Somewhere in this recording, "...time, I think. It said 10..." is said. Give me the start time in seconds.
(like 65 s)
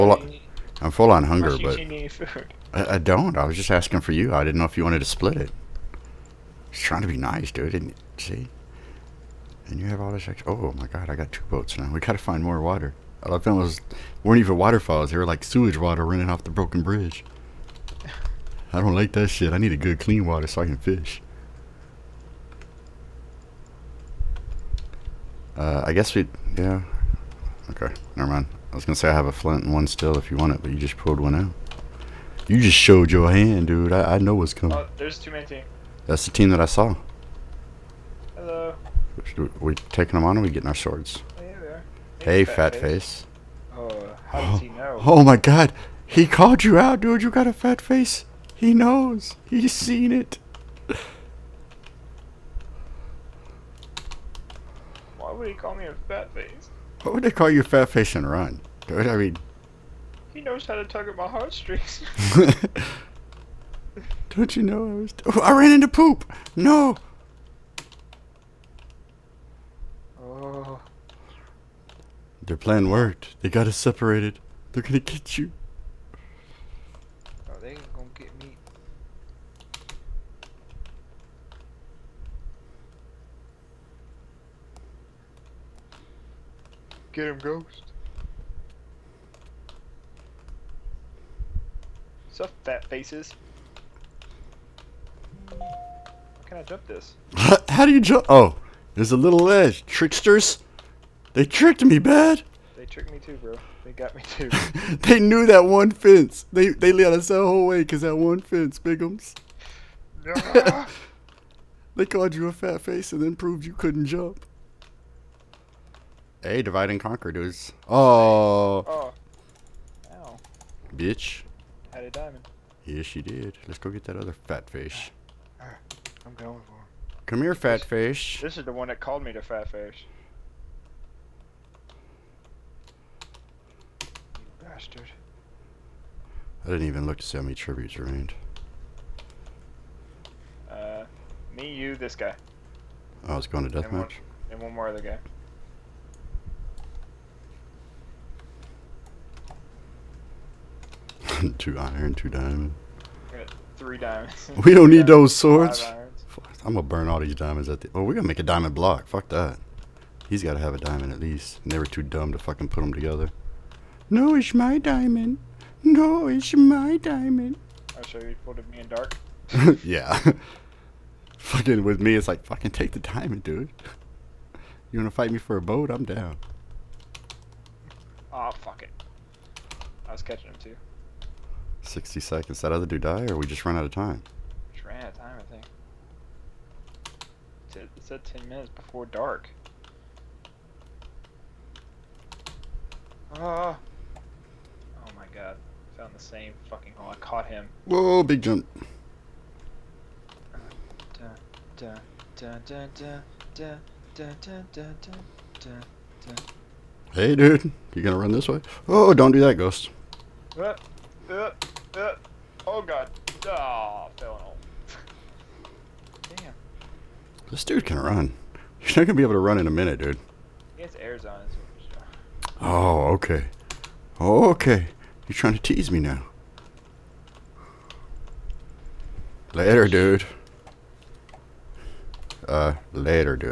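185 s.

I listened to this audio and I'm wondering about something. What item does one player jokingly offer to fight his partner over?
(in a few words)
A boat.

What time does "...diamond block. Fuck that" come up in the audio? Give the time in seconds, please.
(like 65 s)
158 s.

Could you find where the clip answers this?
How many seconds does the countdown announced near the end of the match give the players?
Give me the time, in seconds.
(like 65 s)
181 s.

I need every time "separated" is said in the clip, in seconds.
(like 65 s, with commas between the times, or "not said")
73 s.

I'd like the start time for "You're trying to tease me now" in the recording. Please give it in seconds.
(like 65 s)
225 s.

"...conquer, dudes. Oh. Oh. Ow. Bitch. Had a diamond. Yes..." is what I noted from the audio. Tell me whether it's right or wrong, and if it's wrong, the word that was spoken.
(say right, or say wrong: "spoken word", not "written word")
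right.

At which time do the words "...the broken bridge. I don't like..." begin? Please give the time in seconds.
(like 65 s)
16 s.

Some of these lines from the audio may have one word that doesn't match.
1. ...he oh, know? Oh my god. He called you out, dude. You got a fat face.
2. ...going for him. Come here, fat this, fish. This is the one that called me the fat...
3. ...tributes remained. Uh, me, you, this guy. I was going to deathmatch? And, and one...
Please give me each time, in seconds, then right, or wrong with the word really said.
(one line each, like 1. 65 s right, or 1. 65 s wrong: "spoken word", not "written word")
1. 44 s right
2. 126 s right
3. 137 s right.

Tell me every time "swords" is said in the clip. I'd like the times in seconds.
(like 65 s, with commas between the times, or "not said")
40 s, 155 s.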